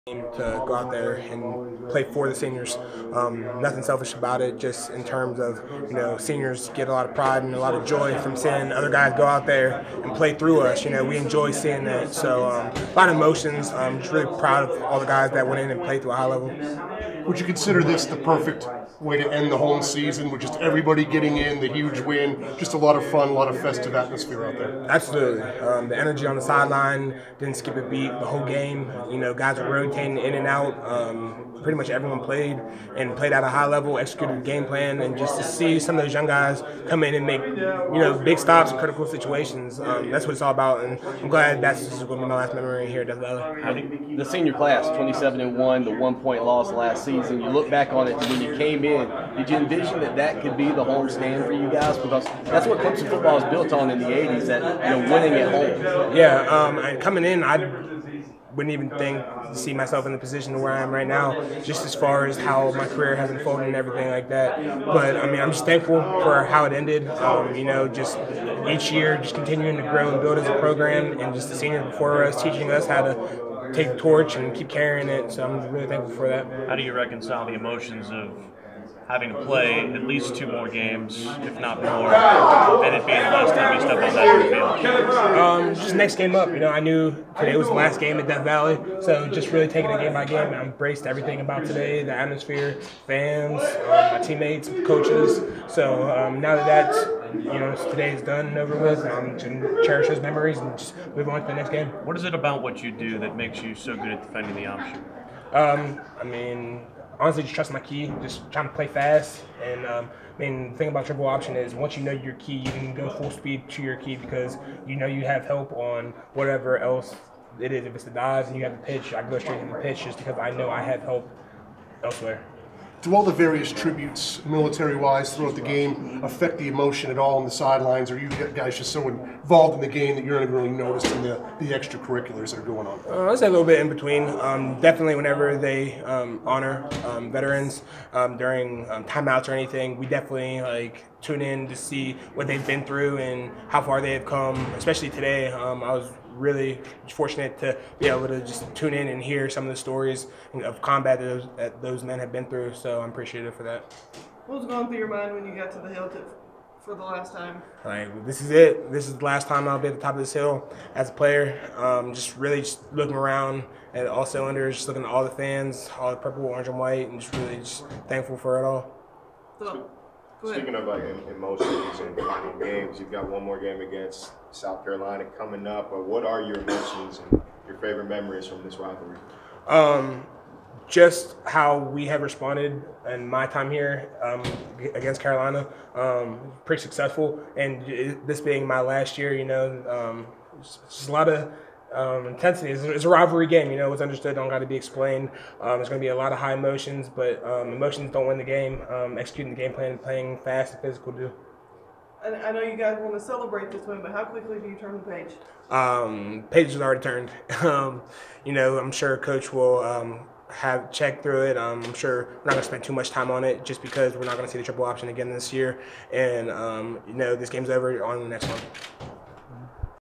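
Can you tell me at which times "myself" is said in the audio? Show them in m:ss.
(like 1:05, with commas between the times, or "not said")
0:59.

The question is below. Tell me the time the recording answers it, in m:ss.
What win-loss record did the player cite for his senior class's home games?
0:44.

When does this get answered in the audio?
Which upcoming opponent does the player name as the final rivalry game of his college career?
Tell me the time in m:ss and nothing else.
2:54.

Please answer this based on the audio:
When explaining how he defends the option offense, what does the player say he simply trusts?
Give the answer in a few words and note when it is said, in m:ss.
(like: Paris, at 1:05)
My key, at 1:47.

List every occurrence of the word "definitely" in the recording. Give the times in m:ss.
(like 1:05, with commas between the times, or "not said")
2:14, 2:20.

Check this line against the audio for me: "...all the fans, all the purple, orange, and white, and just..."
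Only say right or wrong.
right.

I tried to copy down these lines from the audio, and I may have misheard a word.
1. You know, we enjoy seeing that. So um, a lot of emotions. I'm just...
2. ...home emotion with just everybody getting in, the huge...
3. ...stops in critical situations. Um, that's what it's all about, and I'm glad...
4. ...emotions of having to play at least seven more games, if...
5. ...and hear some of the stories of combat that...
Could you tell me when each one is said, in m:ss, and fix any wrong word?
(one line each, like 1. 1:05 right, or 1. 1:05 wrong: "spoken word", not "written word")
1. 0:10 right
2. 0:19 wrong: "season", not "emotion"
3. 0:38 right
4. 1:17 wrong: "two", not "seven"
5. 2:29 right.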